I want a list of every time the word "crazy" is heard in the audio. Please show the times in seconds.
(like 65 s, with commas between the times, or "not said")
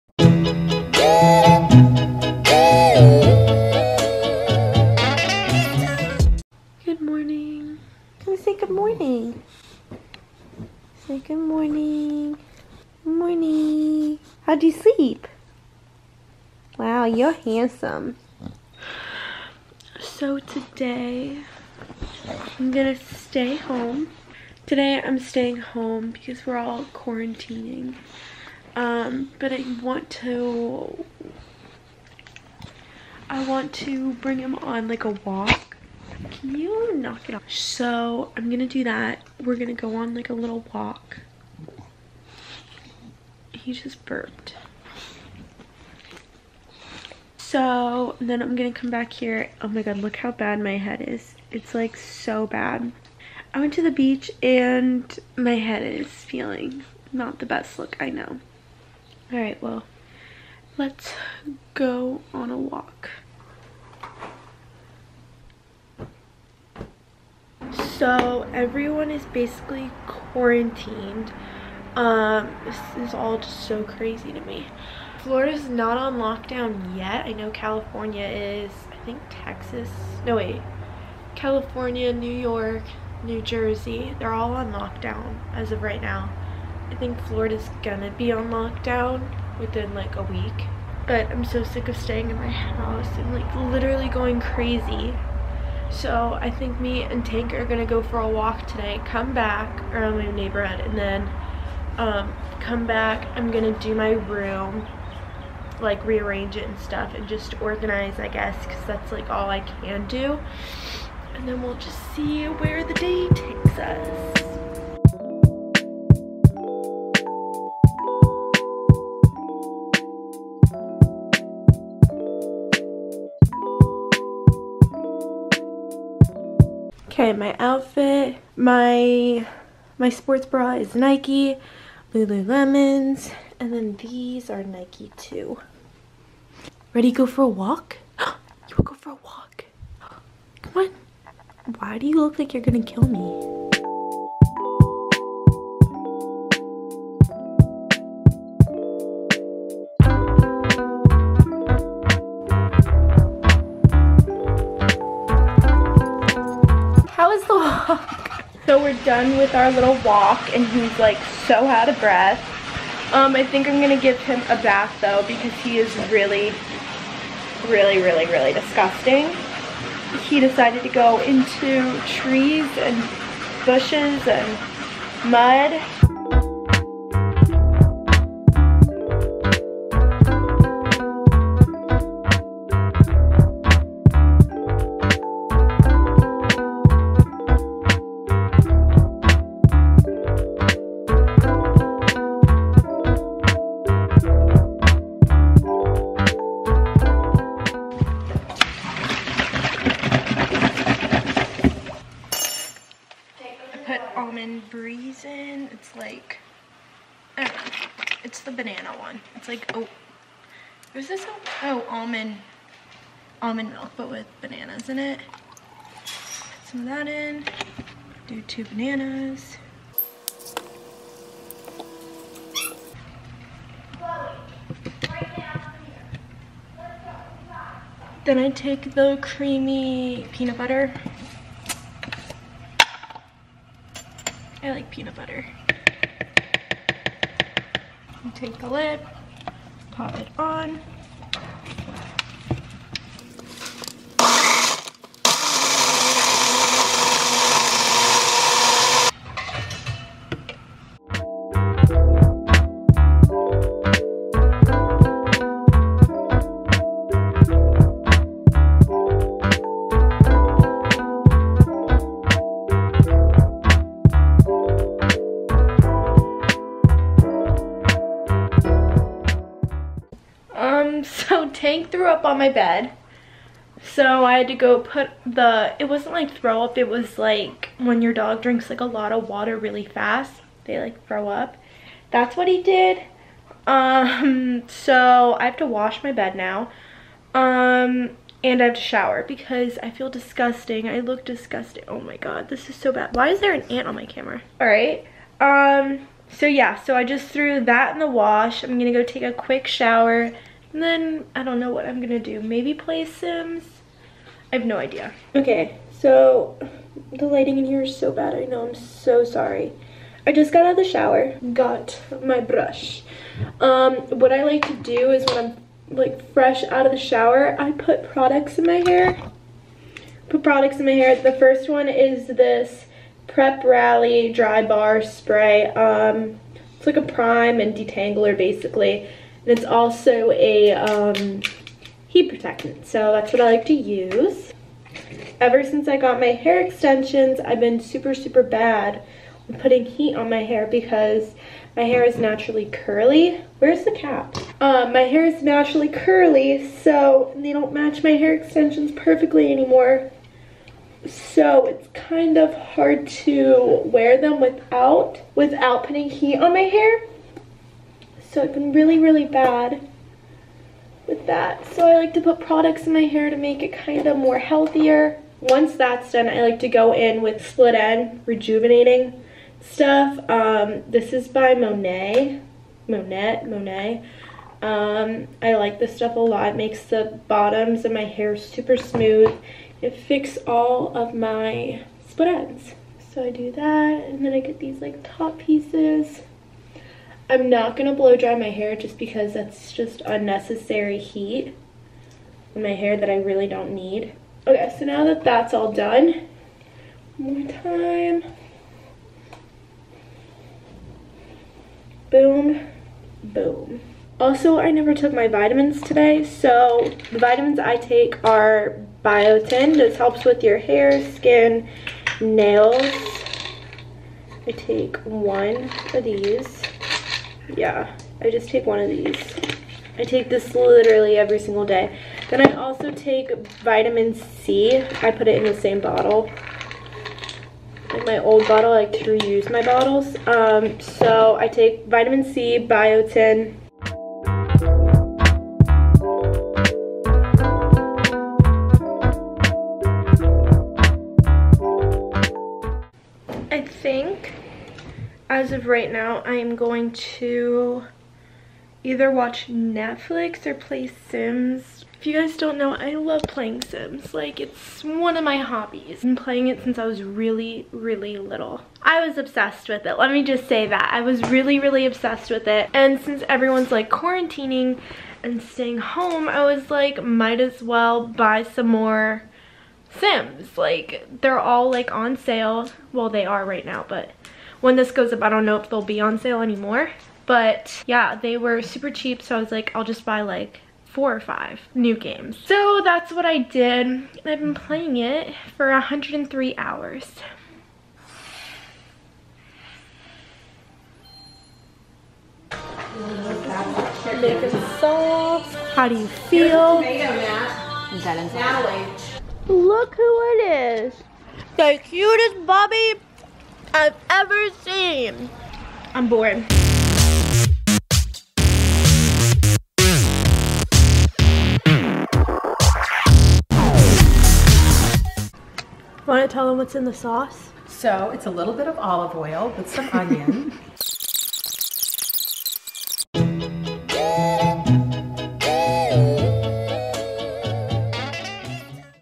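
73 s, 94 s.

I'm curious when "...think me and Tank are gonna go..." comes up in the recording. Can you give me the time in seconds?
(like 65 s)
96 s.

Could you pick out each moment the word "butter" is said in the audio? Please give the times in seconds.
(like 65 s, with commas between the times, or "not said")
230 s, 235 s.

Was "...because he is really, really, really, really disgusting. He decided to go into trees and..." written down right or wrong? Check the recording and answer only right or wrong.
right.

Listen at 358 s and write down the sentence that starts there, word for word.
So I've been really, really bad with that.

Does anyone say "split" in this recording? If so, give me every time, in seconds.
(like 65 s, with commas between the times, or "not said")
367 s, 382 s.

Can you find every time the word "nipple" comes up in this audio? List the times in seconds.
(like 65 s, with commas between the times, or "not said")
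not said.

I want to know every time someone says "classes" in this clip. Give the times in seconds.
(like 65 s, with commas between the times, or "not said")
not said.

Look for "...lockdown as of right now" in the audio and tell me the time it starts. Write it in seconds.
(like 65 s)
84 s.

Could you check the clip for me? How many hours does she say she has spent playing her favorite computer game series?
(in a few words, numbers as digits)
103.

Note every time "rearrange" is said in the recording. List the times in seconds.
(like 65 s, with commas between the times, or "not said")
106 s.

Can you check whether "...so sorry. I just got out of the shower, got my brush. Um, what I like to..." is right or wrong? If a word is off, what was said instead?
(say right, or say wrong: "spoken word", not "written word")
right.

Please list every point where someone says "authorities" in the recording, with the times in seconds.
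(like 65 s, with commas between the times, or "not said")
not said.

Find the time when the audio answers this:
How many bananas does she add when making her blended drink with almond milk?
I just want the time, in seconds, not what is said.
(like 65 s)
218 s.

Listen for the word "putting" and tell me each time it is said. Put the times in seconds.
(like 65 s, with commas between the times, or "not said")
339 s, 355 s.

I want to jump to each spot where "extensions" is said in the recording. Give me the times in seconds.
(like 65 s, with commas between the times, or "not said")
336 s, 348 s.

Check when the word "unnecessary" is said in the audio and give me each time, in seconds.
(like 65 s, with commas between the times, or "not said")
390 s.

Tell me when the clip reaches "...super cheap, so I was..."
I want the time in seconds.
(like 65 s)
478 s.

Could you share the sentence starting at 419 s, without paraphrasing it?
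I take this literally every single day.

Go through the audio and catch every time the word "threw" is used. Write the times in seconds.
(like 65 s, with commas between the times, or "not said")
271 s, 297 s.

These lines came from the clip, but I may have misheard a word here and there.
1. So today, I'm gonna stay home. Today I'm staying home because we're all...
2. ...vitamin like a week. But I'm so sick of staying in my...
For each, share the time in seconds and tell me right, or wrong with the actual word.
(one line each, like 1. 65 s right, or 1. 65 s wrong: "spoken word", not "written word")
1. 19 s right
2. 89 s wrong: "within", not "vitamin".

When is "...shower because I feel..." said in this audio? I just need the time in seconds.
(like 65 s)
288 s.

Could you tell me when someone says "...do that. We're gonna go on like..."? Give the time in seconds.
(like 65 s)
38 s.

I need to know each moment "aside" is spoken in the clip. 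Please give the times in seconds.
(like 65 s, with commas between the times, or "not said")
not said.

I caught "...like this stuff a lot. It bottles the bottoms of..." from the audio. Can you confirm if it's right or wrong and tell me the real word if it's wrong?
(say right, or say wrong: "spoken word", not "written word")
wrong: "makes", not "bottles".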